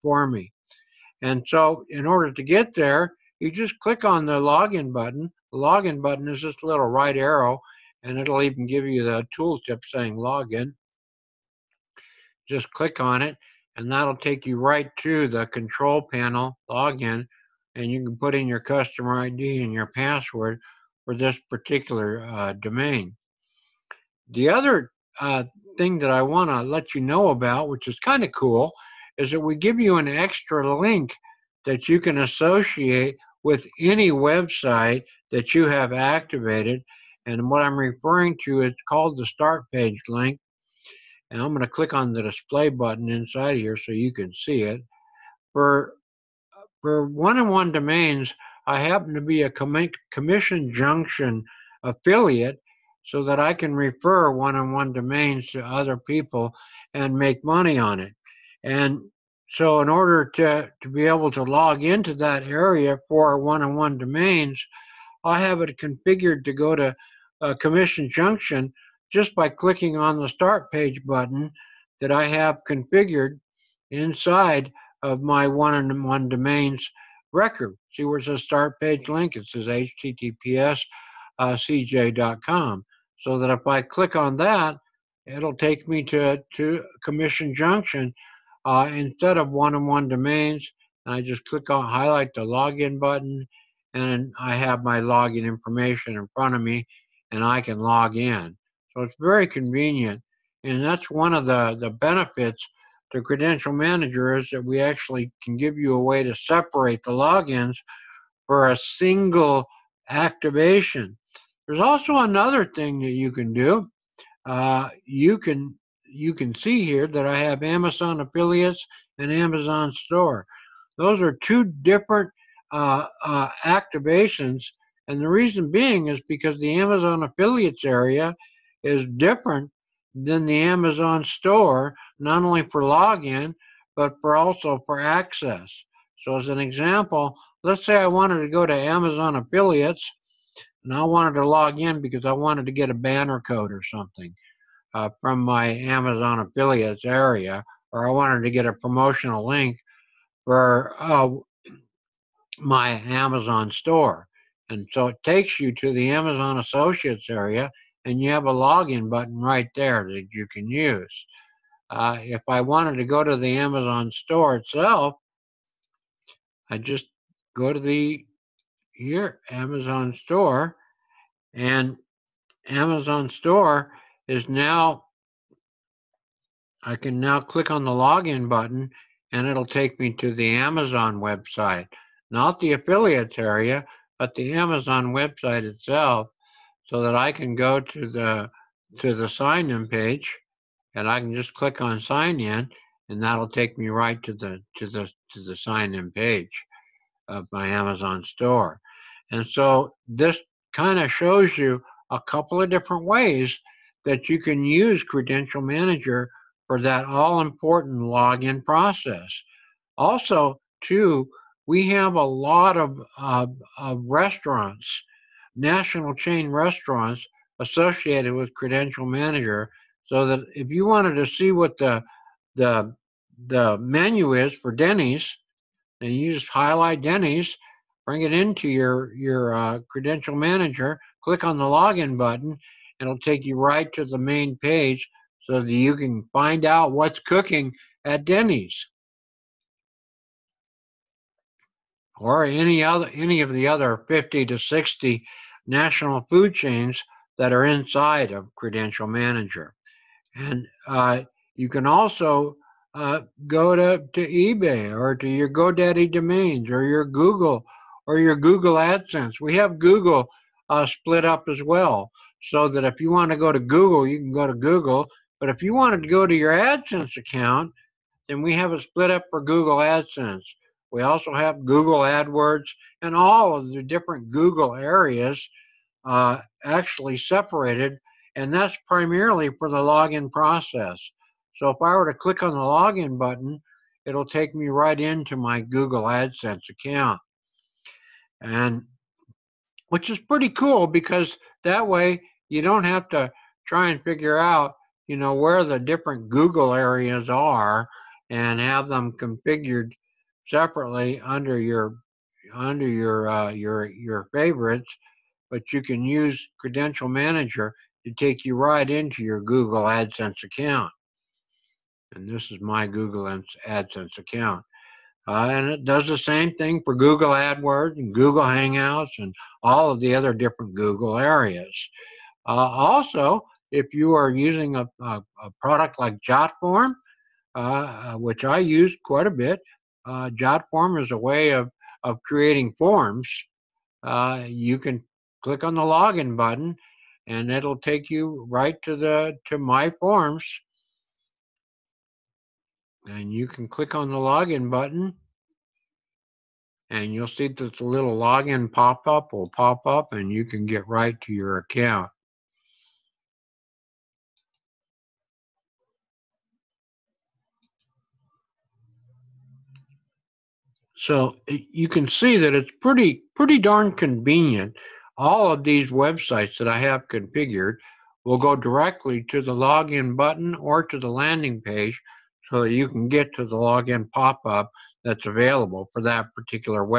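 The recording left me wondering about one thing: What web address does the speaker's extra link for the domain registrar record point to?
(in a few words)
cj.com.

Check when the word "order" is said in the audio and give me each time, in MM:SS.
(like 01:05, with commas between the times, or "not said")
00:02, 00:59.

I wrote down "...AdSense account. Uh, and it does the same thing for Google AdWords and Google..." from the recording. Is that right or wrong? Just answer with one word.
right.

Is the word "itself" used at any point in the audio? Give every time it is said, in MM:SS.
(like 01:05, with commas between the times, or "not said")
02:44, 03:05.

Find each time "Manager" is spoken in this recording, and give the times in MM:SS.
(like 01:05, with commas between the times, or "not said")
01:43, 03:25, 03:39, 03:50, 04:09, 05:07.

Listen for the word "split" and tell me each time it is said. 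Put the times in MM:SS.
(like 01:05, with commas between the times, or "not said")
04:20, 04:28.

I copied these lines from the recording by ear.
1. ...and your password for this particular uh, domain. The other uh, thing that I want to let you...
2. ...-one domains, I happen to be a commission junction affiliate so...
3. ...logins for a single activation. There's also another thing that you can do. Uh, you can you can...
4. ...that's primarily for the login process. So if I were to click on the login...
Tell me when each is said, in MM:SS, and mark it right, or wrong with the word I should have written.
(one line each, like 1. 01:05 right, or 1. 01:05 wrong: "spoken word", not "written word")
1. 00:19 right
2. 00:47 right
3. 01:47 right
4. 04:38 right.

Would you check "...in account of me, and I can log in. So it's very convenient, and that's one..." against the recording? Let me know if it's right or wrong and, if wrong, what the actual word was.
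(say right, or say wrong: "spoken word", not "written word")
wrong: "front", not "account".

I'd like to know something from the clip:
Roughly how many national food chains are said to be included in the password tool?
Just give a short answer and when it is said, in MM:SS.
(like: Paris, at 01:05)
50 to 60, at 04:04.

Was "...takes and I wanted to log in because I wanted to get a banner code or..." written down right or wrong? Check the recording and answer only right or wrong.
wrong.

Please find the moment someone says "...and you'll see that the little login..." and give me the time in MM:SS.
05:46.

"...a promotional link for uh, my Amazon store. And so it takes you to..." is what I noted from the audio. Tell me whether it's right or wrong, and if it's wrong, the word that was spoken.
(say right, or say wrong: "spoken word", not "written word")
right.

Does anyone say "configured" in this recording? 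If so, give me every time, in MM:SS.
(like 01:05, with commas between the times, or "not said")
01:05, 01:12, 04:59, 06:07.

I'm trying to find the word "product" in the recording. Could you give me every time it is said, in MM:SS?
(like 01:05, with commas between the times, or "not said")
05:25.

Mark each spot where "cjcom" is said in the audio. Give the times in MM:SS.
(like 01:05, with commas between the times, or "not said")
01:21.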